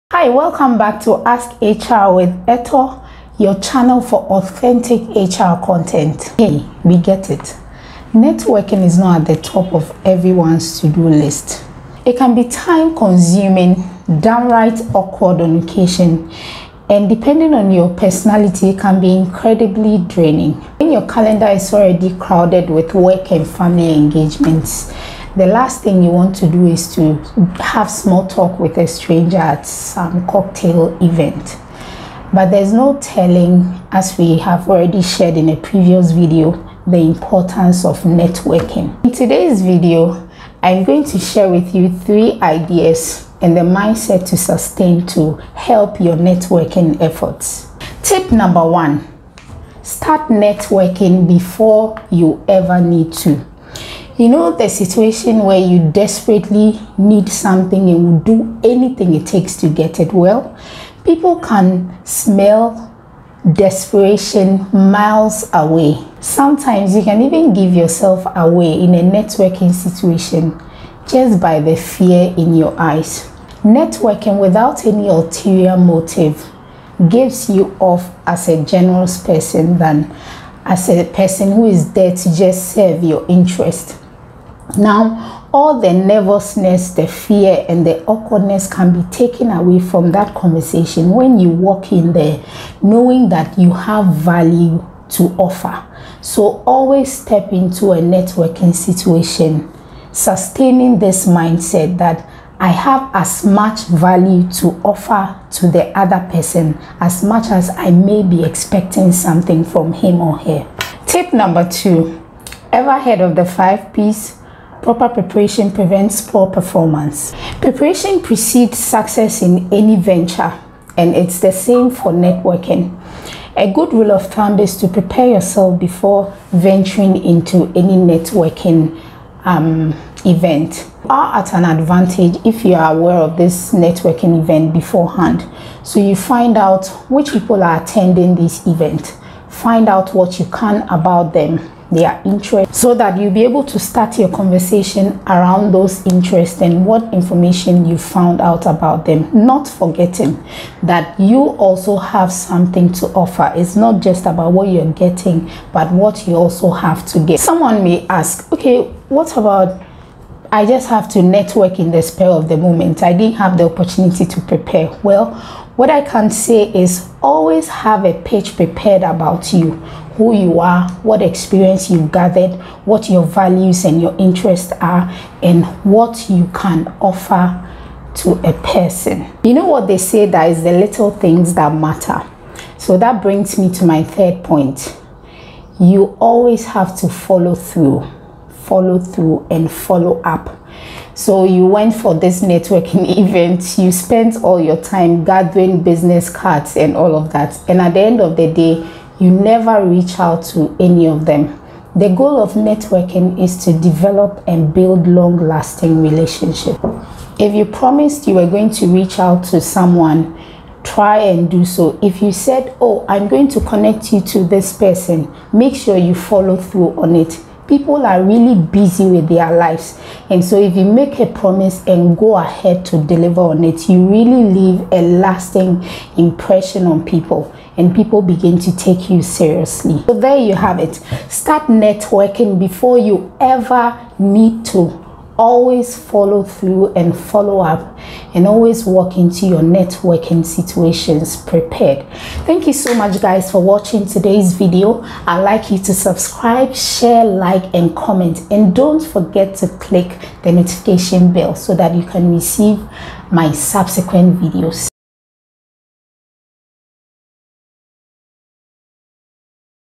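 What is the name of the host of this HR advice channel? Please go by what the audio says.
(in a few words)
Eto.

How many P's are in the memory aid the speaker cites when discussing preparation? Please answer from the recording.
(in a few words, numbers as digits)
5.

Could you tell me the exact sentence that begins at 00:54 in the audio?
You know, the situation where you desperately need something and will do anything it takes to get it.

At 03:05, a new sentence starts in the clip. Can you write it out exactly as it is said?
You always have to follow through, follow through, and follow up.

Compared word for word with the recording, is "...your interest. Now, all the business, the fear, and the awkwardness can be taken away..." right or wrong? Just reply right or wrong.
wrong.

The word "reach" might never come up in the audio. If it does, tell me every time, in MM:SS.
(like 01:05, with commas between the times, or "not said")
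03:19, 03:28.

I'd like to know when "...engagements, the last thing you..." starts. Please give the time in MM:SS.
00:23.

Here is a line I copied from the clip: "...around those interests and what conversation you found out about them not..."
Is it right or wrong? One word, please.
wrong.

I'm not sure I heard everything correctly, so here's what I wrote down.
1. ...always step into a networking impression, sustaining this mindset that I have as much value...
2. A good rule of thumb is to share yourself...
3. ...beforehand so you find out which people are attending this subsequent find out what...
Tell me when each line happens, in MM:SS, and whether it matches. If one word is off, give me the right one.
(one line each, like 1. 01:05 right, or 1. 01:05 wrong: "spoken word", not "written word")
1. 01:36 wrong: "situation", not "impression"
2. 02:03 wrong: "prepare", not "share"
3. 02:14 wrong: "event", not "subsequent".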